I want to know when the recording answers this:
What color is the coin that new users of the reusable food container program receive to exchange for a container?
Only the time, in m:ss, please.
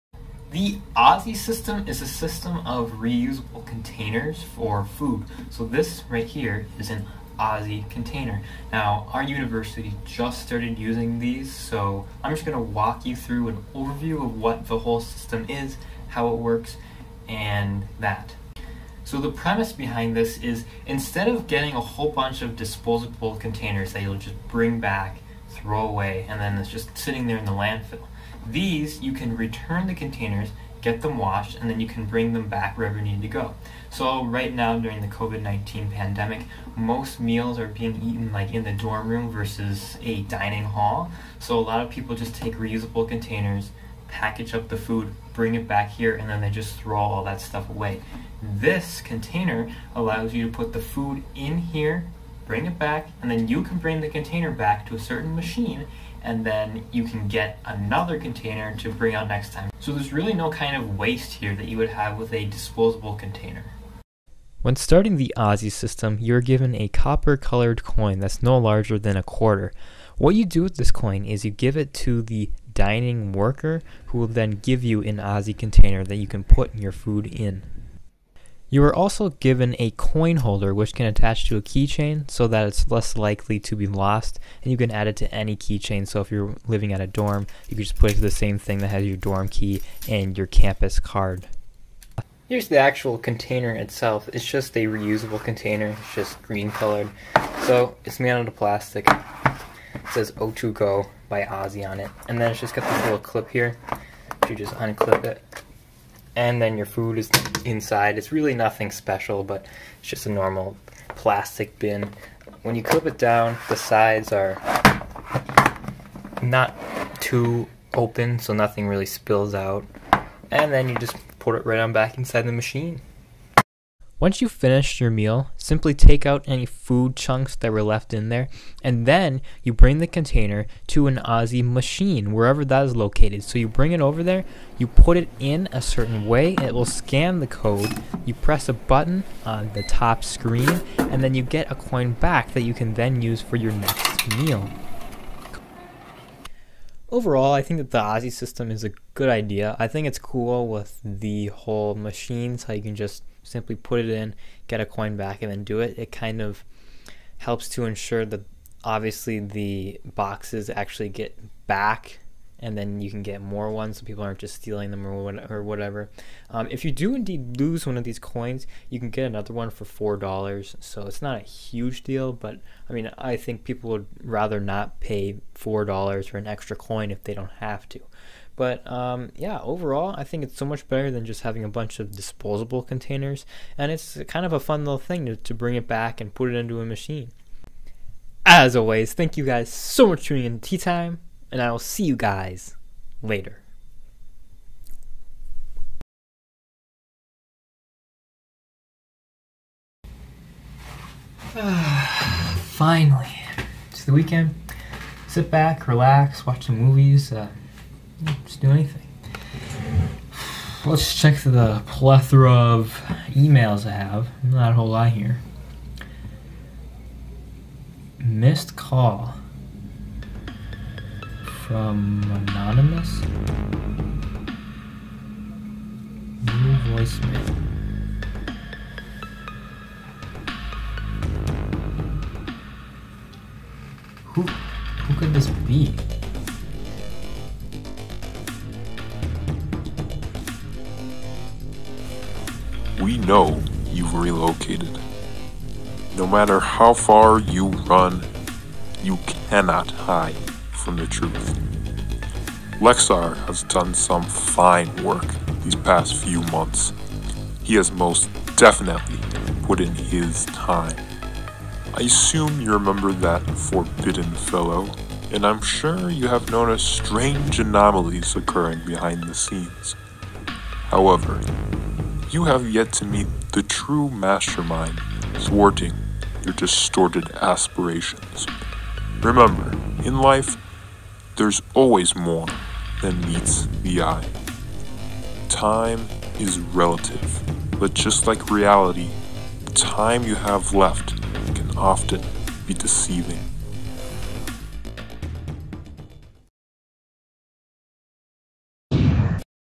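1:06.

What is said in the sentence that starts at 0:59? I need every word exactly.
So there's really no kind of waste here that you would have with a disposable container.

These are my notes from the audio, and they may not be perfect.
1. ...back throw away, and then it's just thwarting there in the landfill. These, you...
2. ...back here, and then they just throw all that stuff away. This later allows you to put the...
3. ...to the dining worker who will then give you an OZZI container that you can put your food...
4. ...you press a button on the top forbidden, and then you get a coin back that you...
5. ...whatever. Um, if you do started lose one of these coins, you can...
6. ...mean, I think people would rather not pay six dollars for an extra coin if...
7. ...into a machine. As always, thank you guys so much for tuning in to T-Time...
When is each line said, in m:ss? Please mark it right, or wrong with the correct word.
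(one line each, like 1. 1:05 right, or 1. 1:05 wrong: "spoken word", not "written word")
1. 0:24 wrong: "sitting", not "thwarting"
2. 0:45 wrong: "container", not "later"
3. 1:12 right
4. 2:18 wrong: "screen", not "forbidden"
5. 2:45 wrong: "indeed", not "started"
6. 2:52 wrong: "four", not "six"
7. 3:06 right.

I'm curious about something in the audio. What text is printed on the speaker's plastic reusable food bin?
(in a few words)
O2Go by OZZI.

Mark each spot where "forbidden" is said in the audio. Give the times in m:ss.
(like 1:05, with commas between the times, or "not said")
4:23.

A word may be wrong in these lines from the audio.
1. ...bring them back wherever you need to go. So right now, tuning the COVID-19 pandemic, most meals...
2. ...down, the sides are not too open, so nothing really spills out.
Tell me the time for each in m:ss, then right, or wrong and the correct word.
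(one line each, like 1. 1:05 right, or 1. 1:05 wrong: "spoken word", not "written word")
1. 0:32 wrong: "during", not "tuning"
2. 1:53 right.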